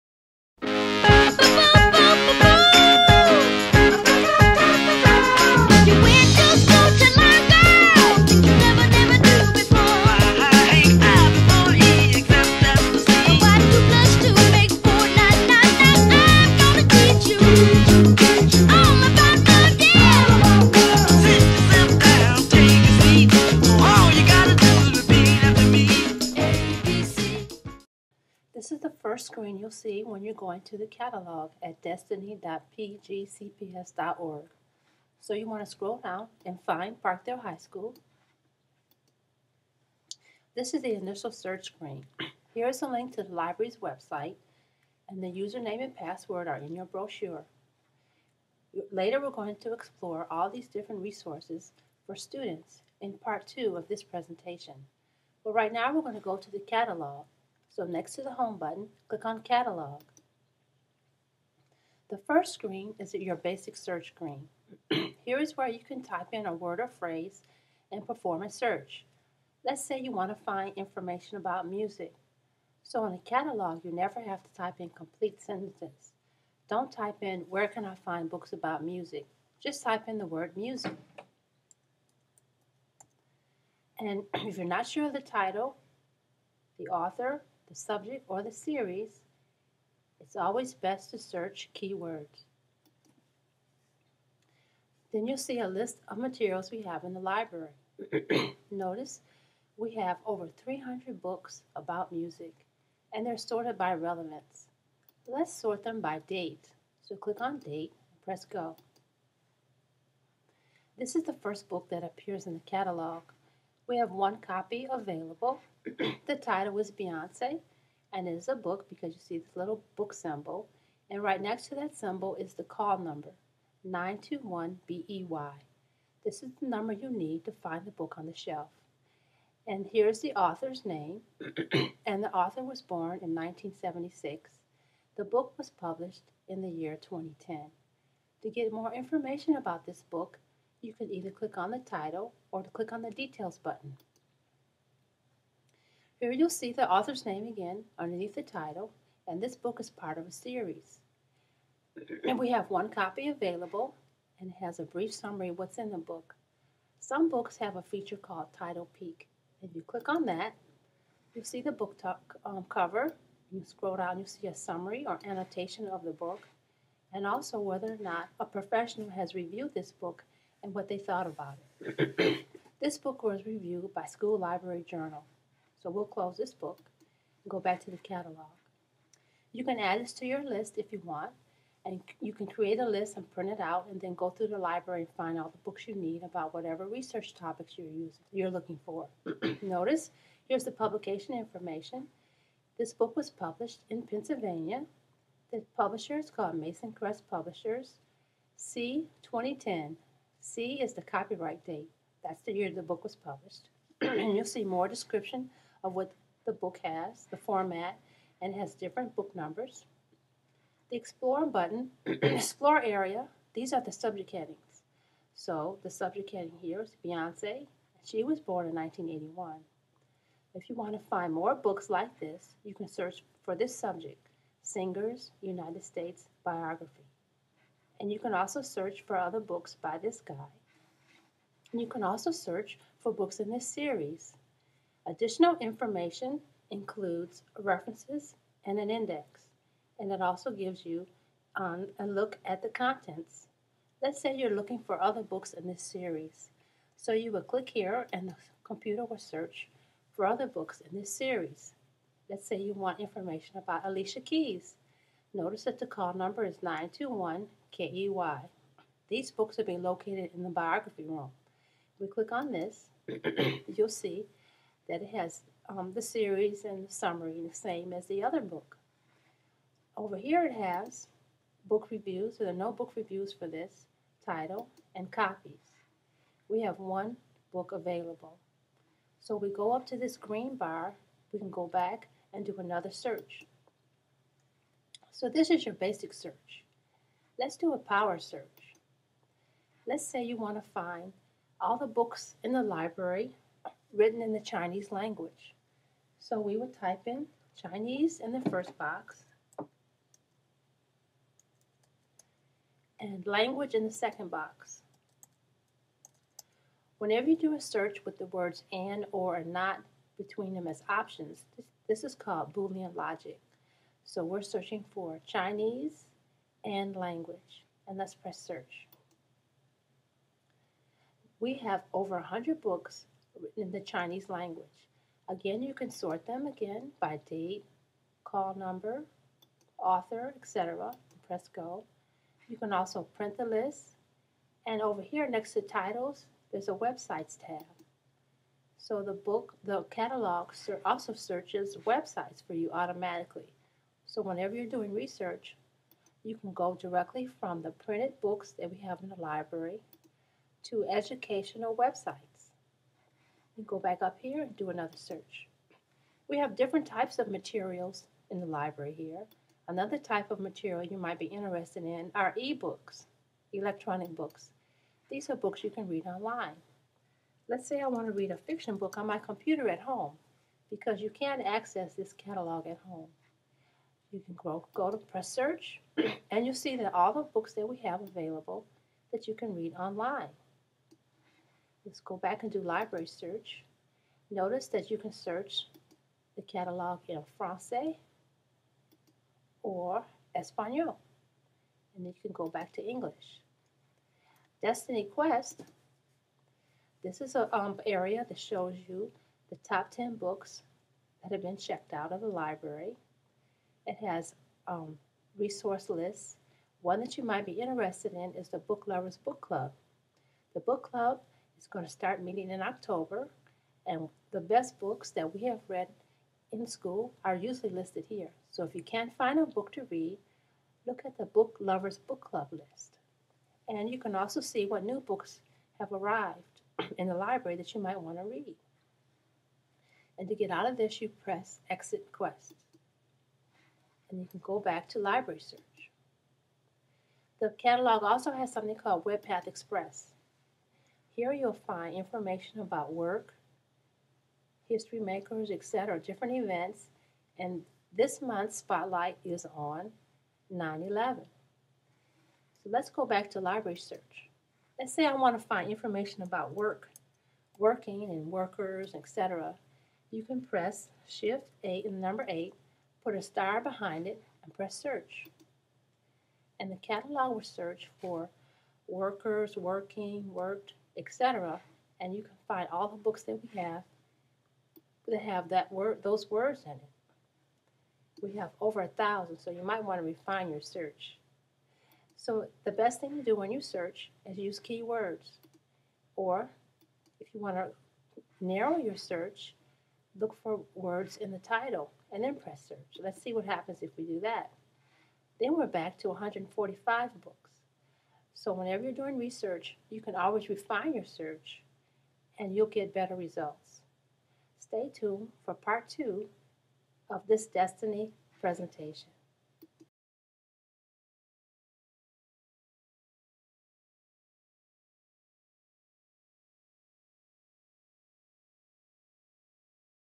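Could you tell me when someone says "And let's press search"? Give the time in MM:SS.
05:17.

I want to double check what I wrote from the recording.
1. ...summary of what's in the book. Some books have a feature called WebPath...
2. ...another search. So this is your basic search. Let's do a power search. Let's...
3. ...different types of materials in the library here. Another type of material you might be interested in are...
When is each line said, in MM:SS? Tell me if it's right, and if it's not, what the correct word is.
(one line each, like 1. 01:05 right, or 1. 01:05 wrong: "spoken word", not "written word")
1. 02:35 wrong: "Title", not "WebPath"
2. 04:42 right
3. 05:56 right.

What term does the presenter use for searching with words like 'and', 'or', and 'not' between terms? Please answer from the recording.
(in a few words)
Boolean logic.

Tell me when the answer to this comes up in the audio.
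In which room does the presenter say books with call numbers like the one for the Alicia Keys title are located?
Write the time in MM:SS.
04:20.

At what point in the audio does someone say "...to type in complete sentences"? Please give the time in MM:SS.
01:14.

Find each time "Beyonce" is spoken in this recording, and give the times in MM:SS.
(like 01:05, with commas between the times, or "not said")
01:56, 03:37.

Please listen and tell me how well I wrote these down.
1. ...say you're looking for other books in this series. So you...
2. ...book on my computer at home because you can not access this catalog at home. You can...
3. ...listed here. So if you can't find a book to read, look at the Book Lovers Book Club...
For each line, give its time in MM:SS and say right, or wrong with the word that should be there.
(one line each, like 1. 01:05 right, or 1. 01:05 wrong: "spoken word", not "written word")
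1. 04:04 right
2. 06:08 right
3. 06:57 right.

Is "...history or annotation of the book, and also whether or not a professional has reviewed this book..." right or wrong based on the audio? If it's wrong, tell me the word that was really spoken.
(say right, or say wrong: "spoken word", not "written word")
wrong: "summary", not "history".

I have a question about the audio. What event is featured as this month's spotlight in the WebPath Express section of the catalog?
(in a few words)
9-11.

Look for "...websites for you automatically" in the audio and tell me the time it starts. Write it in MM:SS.
05:41.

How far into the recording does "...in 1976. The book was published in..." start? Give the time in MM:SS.
02:13.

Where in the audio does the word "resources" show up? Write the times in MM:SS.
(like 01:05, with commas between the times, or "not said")
00:51, 06:45.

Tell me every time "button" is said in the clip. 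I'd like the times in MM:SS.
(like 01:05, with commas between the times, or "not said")
00:58, 02:23, 03:31.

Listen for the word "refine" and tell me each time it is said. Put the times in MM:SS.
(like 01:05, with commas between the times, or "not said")
08:00, 08:20.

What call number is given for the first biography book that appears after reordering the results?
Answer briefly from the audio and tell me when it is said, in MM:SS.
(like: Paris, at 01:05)
921BEY, at 02:03.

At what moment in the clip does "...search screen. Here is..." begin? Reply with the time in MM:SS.
00:41.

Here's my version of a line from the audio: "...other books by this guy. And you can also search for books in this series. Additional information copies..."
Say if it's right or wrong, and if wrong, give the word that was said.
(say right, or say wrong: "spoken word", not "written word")
wrong: "includes", not "copies".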